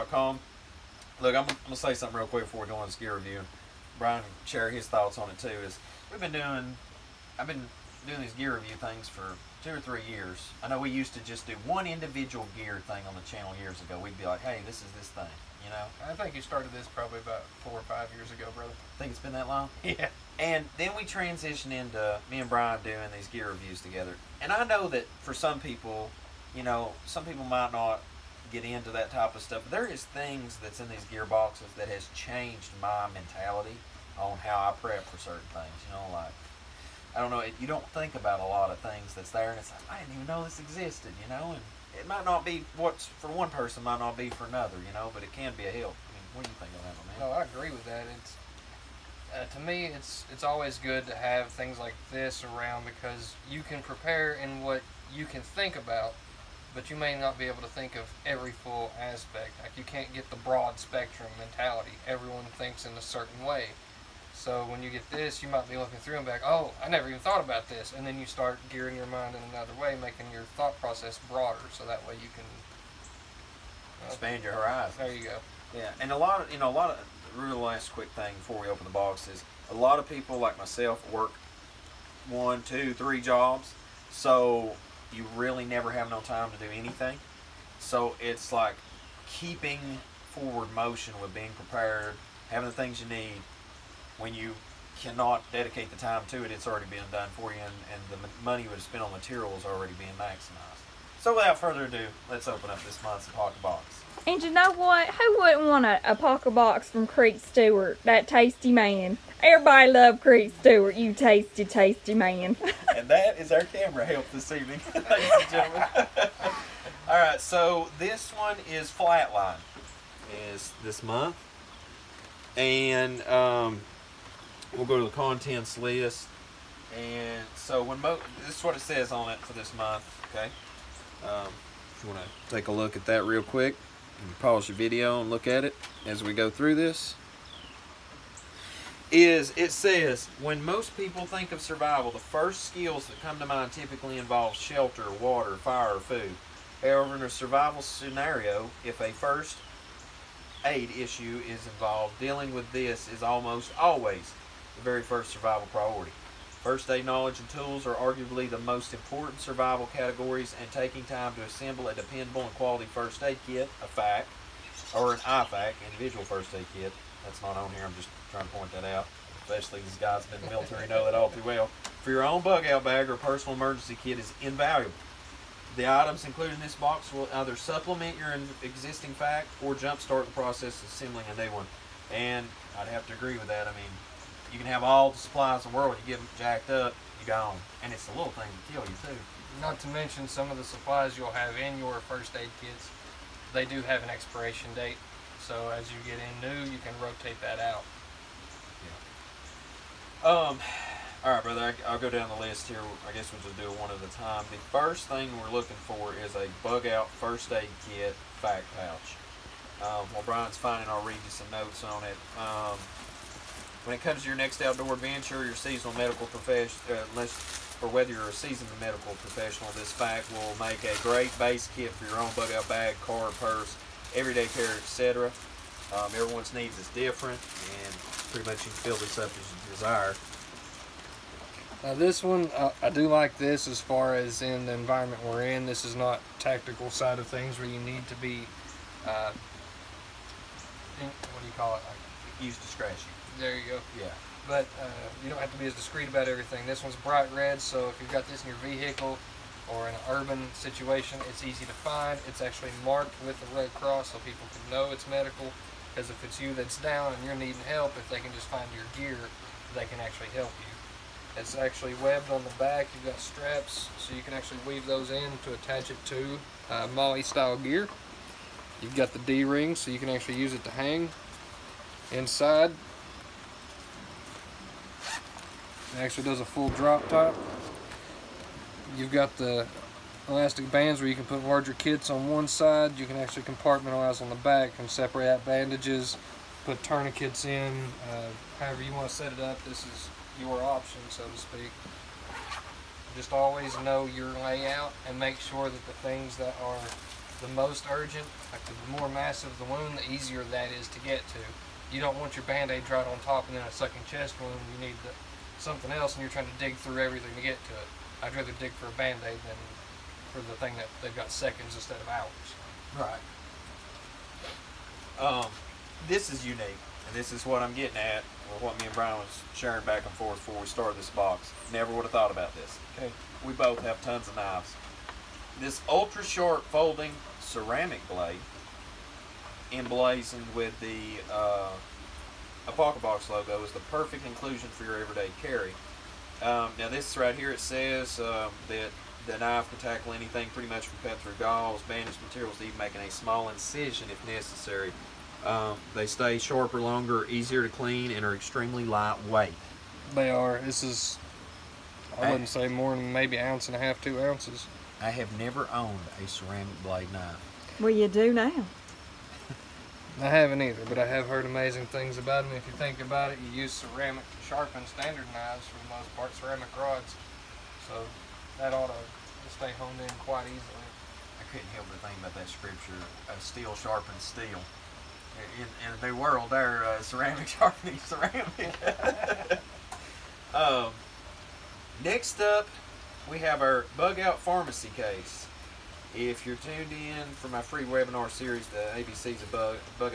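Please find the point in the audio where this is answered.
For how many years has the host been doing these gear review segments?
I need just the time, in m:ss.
0:09.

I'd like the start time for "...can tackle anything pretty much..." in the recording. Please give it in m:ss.
5:39.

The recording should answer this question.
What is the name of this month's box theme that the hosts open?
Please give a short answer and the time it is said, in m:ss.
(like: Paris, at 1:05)
Flatline, at 1:58.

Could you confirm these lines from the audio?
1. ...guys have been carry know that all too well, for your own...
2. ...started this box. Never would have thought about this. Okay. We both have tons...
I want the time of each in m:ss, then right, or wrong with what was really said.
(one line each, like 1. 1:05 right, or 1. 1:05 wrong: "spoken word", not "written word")
1. 2:49 wrong: "military", not "carry"
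2. 5:20 right.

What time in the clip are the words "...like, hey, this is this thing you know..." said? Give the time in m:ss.
0:14.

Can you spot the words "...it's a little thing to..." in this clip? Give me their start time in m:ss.
3:07.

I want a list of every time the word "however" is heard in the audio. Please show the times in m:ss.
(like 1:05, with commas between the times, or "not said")
2:26, 4:48.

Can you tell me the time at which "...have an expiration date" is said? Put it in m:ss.
3:13.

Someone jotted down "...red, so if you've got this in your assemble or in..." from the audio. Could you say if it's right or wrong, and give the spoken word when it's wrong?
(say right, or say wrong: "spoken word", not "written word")
wrong: "vehicle", not "assemble".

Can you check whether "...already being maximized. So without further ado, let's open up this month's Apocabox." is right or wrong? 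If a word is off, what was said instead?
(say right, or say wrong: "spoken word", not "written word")
right.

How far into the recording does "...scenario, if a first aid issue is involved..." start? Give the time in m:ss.
2:27.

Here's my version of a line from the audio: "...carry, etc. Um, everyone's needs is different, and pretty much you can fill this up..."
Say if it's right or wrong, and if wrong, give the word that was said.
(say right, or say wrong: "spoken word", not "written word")
right.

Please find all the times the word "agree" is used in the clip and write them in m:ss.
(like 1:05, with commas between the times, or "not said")
0:47, 3:03.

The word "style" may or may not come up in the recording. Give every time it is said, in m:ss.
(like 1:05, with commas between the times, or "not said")
4:26.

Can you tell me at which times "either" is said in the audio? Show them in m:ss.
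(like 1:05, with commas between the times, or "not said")
2:57, 6:00.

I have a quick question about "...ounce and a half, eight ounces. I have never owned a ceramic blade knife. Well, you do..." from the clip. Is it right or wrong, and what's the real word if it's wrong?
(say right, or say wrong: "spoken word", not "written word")
wrong: "two", not "eight".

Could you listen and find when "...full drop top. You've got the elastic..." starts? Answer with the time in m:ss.
4:36.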